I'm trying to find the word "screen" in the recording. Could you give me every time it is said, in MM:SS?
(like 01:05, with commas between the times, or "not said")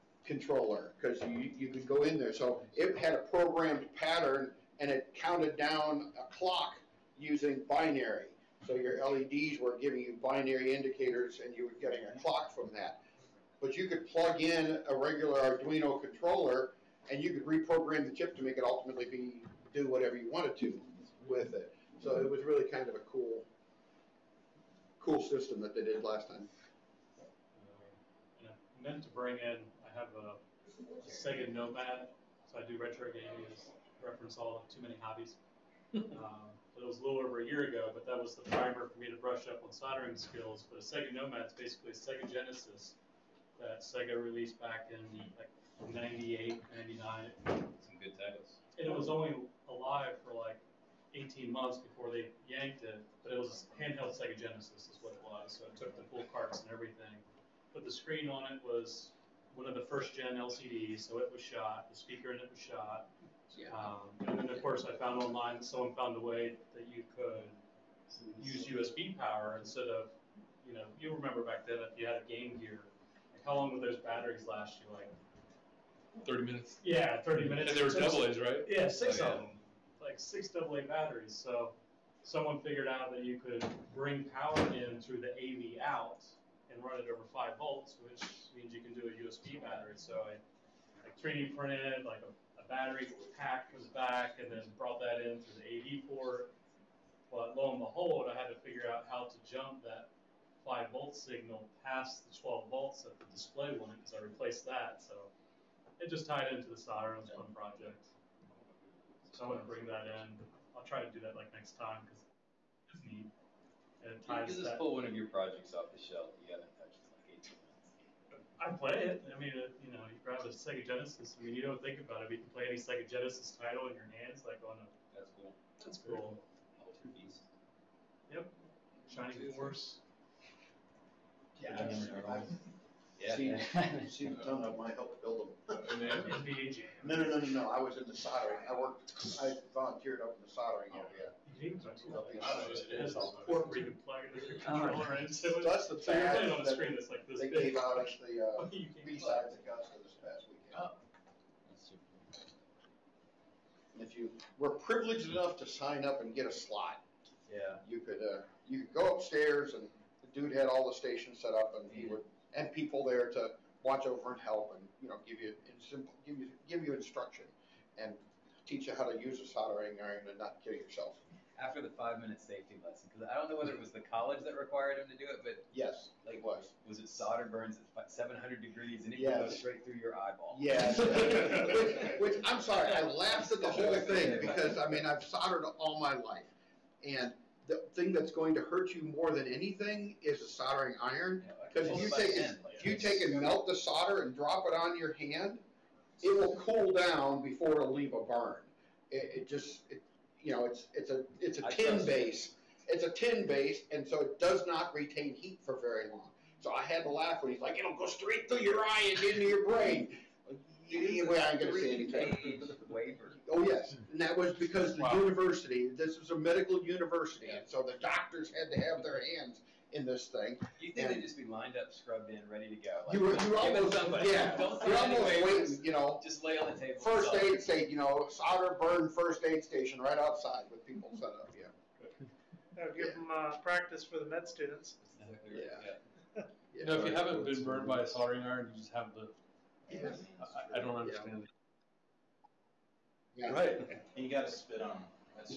00:57, 02:26.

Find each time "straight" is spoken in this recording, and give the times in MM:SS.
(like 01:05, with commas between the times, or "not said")
02:59, 03:28.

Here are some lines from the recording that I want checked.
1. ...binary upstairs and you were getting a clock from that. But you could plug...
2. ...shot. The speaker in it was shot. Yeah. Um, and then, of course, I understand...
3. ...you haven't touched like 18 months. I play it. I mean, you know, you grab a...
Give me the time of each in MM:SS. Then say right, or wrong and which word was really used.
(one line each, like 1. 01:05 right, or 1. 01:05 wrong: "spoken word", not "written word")
1. 00:10 wrong: "indicators", not "upstairs"
2. 01:01 wrong: "found", not "understand"
3. 01:56 right.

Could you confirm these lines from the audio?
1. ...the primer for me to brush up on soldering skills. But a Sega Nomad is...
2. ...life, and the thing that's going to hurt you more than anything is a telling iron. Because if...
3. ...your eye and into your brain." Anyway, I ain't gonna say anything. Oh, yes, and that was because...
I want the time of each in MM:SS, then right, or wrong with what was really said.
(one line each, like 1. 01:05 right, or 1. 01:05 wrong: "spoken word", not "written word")
1. 00:38 right
2. 03:06 wrong: "soldering", not "telling"
3. 03:28 right.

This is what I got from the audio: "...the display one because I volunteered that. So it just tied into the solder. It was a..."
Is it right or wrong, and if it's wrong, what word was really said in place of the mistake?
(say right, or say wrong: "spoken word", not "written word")
wrong: "replaced", not "volunteered".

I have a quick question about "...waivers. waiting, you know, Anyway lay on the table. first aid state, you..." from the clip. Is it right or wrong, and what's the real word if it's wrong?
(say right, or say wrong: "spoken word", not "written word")
wrong: "Just", not "Anyway".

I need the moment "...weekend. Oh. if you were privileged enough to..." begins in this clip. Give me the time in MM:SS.
02:30.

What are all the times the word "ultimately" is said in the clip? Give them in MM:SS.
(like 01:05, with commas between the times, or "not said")
00:18.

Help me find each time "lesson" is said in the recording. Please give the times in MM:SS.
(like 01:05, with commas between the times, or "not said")
02:52.